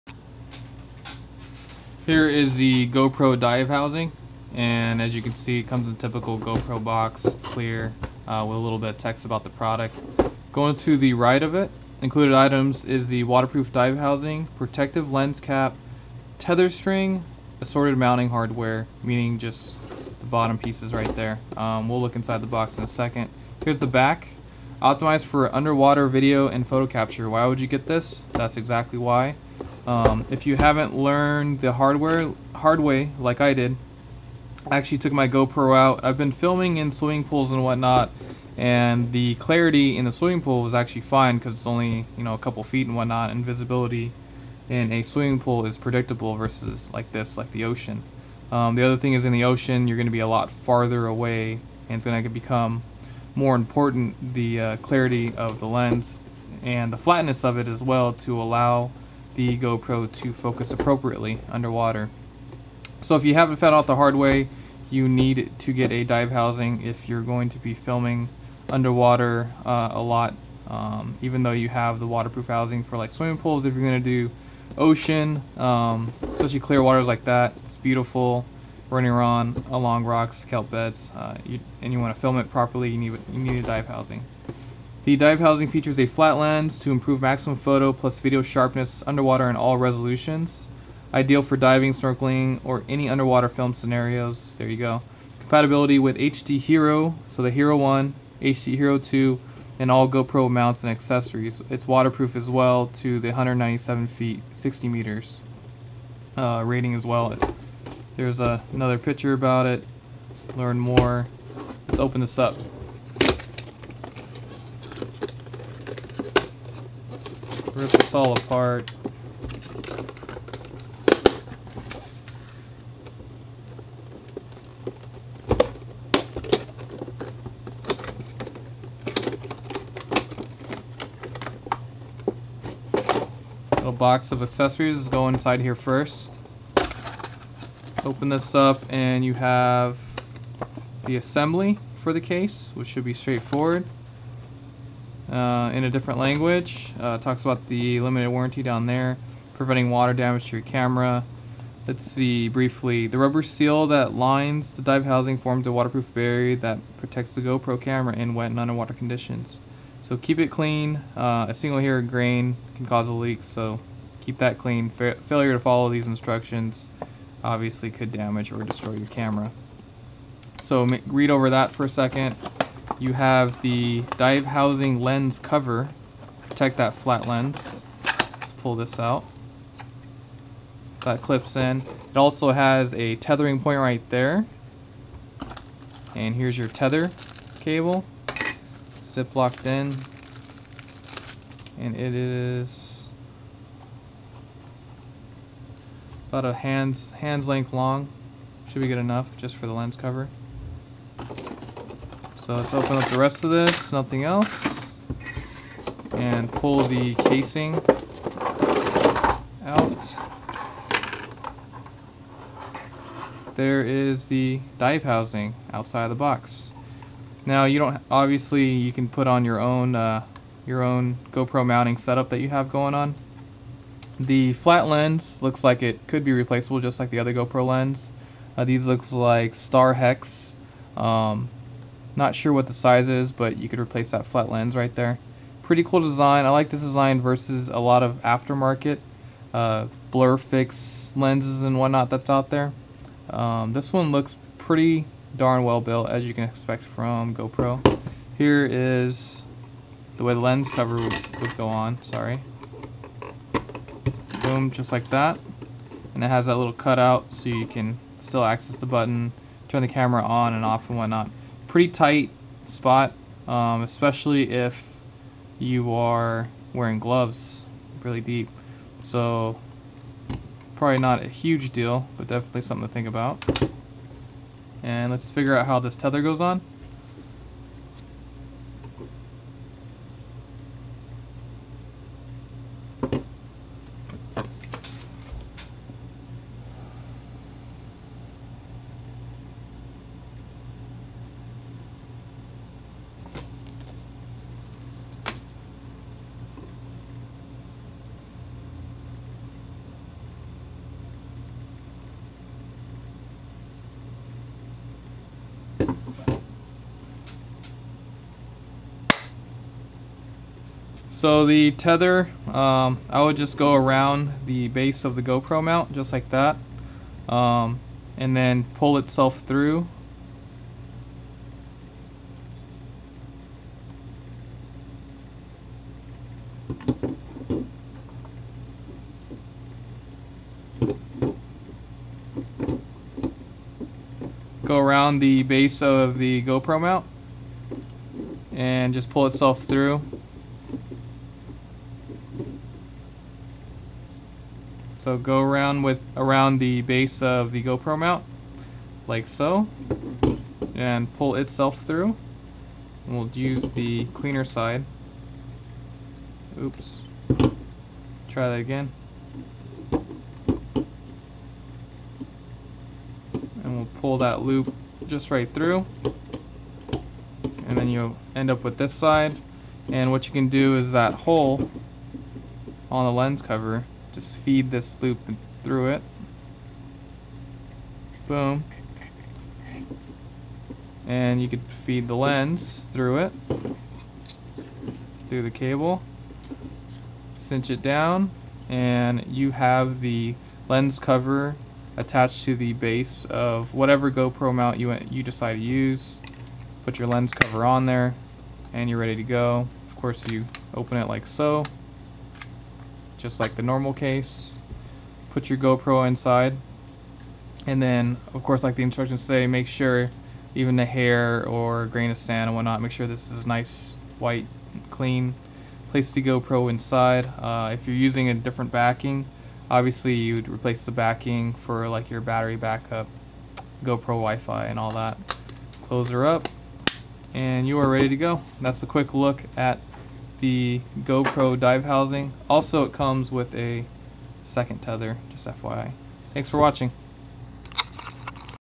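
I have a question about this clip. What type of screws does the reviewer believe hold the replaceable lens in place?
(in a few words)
Star Hex.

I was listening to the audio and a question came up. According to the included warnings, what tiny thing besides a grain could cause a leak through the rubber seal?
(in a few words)
a single hair.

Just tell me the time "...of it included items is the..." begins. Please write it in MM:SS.
00:11.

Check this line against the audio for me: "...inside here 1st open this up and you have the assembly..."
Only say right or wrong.
right.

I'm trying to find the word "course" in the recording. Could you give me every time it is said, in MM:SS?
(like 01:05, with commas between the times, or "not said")
06:39, 06:48.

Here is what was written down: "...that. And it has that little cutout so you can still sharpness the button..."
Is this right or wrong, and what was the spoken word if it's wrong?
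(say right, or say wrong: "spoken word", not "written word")
wrong: "access", not "sharpness".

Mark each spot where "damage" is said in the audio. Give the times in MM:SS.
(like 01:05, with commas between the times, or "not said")
02:30, 02:48.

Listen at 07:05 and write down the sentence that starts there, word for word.
Close her up and you are ready to go.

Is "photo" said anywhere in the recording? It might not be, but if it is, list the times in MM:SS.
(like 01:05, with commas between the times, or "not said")
00:26, 01:27.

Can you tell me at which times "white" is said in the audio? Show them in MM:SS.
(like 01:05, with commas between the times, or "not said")
06:54.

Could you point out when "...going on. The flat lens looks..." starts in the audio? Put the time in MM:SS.
03:42.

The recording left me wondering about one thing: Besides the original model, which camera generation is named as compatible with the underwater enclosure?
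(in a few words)
HD Hero 2.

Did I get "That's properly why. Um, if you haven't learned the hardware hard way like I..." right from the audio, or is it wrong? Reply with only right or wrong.
wrong.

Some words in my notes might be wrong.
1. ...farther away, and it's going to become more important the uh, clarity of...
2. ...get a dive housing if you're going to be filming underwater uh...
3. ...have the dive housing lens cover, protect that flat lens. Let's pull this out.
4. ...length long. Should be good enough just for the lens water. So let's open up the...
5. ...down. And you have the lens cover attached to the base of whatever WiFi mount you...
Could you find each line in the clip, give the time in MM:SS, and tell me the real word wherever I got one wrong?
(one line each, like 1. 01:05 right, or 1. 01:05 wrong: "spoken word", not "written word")
1. 00:50 right
2. 01:05 right
3. 02:53 right
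4. 03:17 wrong: "cover", not "water"
5. 06:27 wrong: "GoPro", not "WiFi".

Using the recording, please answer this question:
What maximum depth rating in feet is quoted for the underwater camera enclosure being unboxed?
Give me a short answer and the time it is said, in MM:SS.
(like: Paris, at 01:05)
197 feet, at 01:43.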